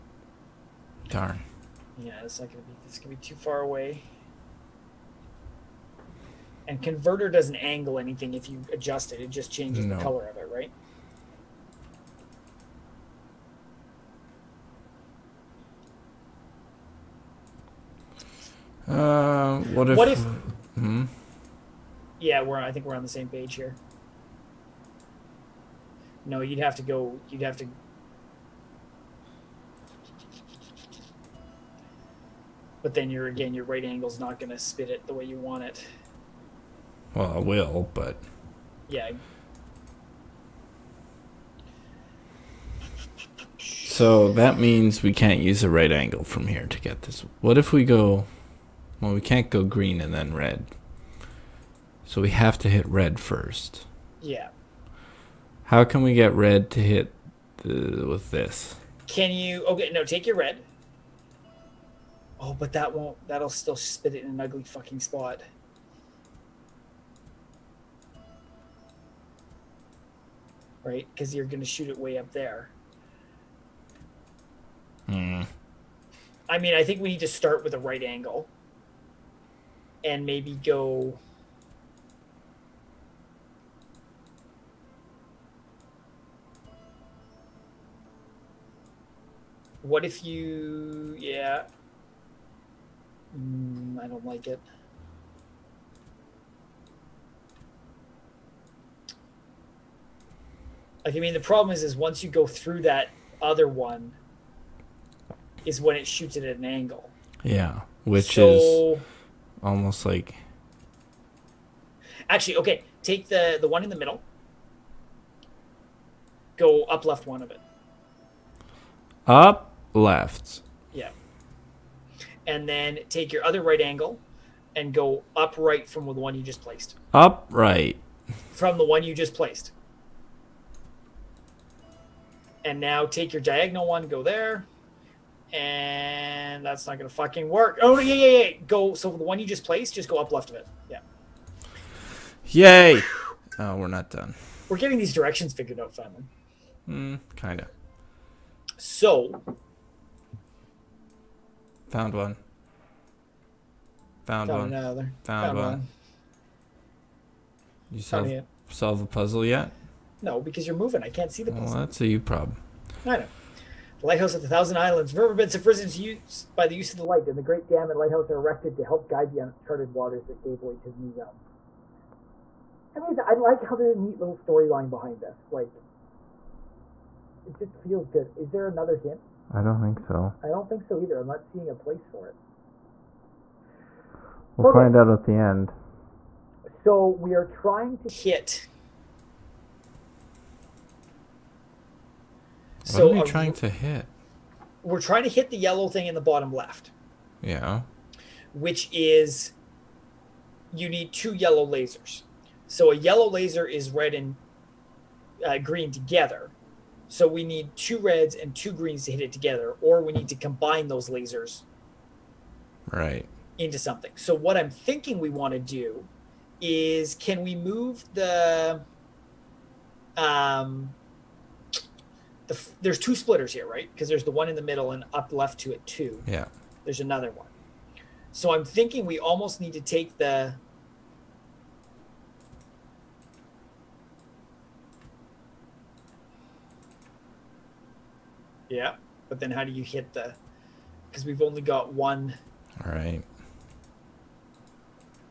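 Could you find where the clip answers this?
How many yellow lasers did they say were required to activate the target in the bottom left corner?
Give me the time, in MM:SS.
03:21.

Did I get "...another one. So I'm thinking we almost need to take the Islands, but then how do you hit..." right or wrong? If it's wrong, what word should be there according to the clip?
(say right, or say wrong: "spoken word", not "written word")
wrong: "Yeah", not "Islands".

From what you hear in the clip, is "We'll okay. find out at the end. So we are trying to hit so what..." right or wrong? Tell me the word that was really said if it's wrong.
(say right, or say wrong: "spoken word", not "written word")
right.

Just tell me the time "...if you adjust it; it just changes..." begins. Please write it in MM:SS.
00:08.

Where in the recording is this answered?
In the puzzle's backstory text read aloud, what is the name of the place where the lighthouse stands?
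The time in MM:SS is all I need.
02:44.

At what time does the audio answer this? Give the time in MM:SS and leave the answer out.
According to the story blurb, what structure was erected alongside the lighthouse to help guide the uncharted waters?
02:47.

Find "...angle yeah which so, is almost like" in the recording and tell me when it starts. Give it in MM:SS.
01:46.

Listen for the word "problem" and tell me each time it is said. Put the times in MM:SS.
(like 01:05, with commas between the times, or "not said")
01:41, 02:42.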